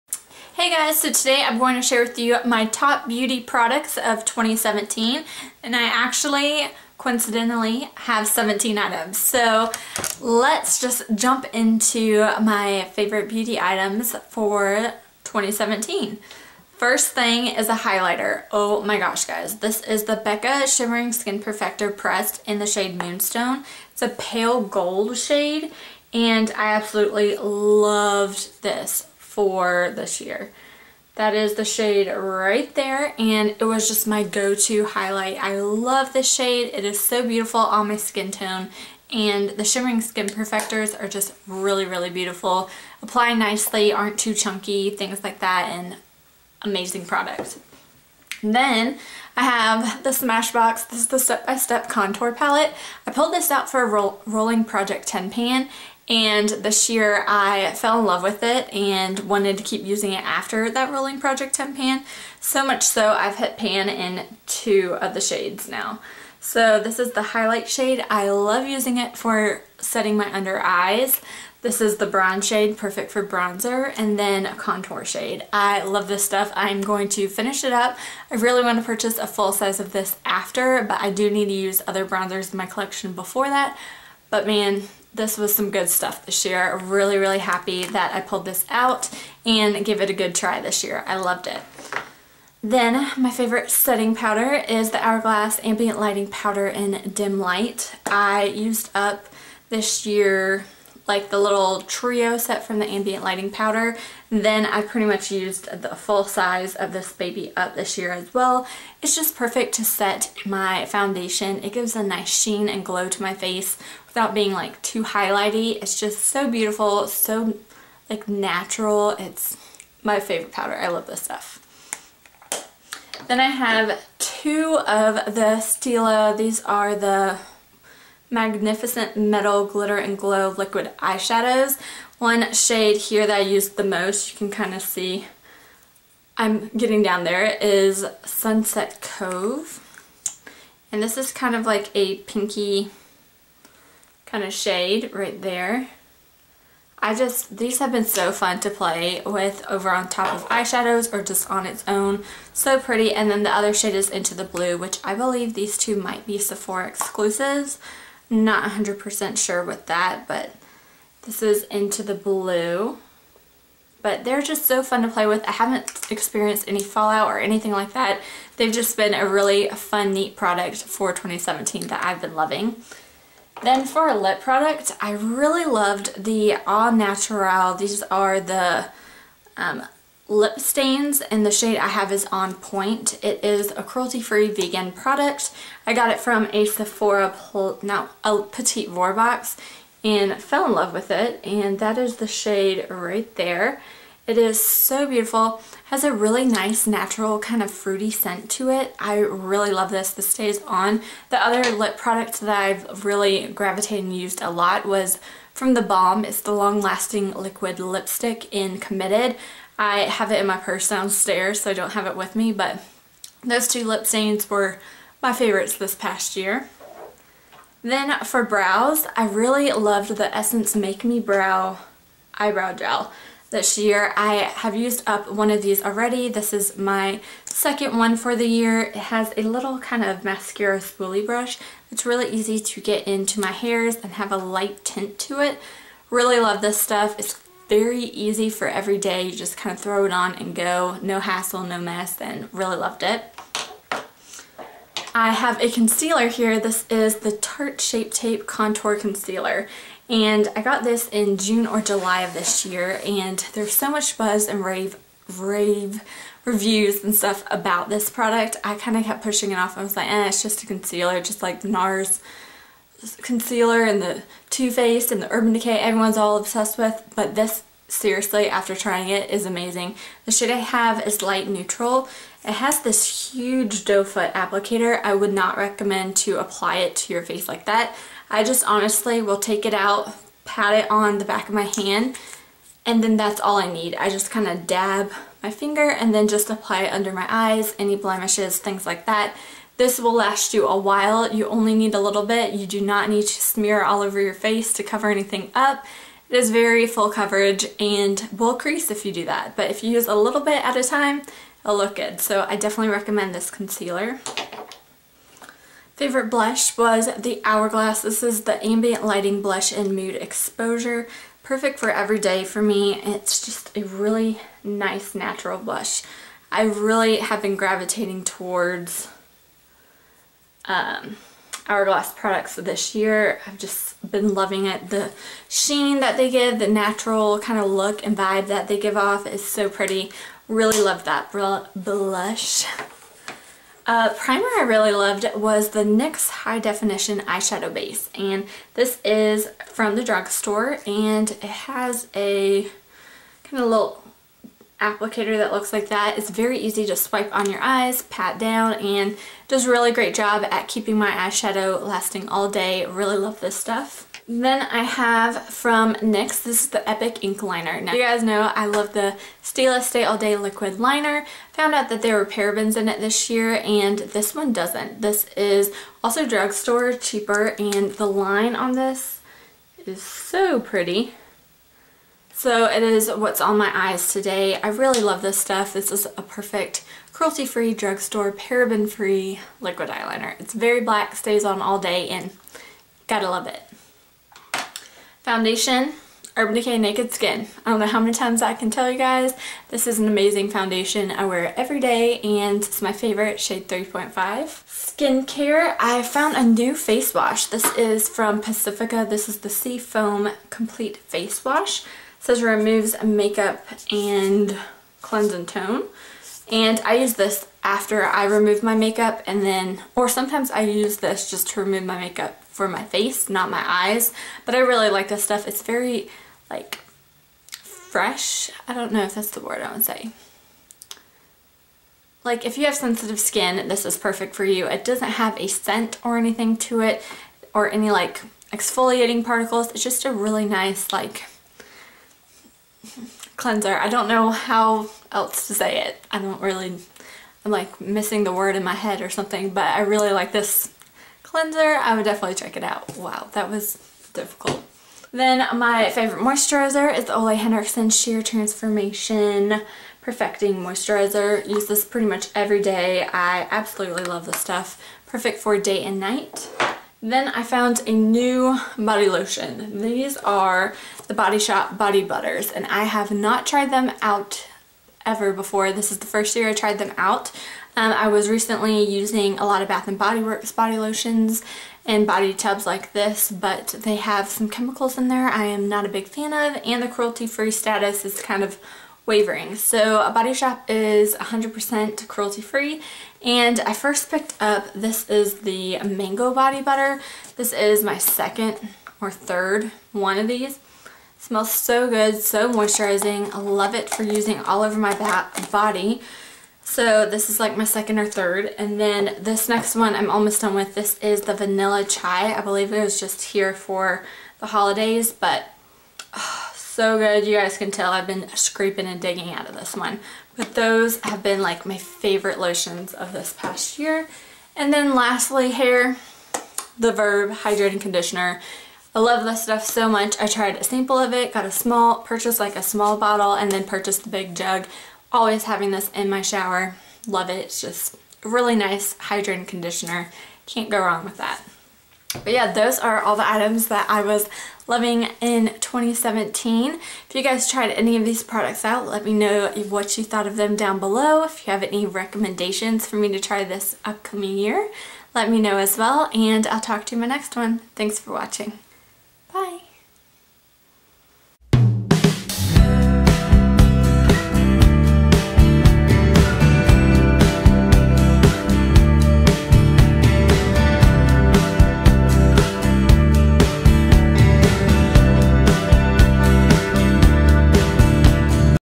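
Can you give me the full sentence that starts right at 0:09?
So let's just jump into my favorite beauty items for 2017.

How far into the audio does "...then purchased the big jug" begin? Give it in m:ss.
8:43.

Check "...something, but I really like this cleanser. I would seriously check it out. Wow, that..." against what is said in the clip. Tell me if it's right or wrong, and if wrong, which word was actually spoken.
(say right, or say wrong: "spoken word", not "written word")
wrong: "definitely", not "seriously".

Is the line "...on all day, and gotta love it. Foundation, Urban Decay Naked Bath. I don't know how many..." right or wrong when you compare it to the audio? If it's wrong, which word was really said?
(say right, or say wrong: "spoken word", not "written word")
wrong: "Skin", not "Bath".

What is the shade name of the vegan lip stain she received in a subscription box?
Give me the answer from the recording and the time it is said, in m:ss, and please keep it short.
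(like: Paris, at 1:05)
On Pointe, at 3:02.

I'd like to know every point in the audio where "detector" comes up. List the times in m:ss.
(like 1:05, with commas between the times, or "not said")
not said.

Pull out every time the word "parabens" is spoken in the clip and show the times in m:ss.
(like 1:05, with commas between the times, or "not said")
6:02, 6:18.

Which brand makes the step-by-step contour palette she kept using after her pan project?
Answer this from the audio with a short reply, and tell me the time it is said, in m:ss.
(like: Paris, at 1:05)
Smashbox, at 0:50.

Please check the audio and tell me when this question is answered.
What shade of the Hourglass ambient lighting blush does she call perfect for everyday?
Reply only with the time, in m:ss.
5:09.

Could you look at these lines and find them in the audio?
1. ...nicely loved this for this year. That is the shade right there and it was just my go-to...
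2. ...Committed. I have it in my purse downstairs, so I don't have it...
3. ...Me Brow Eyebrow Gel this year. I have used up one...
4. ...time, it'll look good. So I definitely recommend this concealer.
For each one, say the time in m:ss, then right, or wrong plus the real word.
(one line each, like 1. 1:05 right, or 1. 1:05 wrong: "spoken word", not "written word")
1. 0:26 wrong: "absolutely", not "nicely"
2. 3:28 right
3. 3:41 right
4. 5:00 right.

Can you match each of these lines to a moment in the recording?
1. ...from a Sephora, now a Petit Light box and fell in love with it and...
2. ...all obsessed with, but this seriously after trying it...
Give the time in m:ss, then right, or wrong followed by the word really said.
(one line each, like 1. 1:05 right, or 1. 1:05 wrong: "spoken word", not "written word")
1. 3:06 wrong: "Vour", not "Light"
2. 4:26 right.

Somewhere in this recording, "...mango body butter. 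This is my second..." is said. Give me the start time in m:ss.
8:05.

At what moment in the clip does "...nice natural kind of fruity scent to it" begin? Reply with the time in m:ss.
3:16.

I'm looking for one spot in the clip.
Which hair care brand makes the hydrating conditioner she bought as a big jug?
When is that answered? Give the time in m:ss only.
8:36.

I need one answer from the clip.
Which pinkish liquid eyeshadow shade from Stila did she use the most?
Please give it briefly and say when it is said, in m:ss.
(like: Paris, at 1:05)
Sunset Cove, at 2:18.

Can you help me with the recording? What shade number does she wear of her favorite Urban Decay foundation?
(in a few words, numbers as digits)
3.5.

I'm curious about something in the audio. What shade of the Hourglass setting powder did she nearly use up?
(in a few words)
Dim Light.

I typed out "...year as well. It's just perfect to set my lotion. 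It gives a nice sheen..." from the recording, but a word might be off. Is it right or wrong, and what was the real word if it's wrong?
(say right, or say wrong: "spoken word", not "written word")
wrong: "foundation", not "lotion".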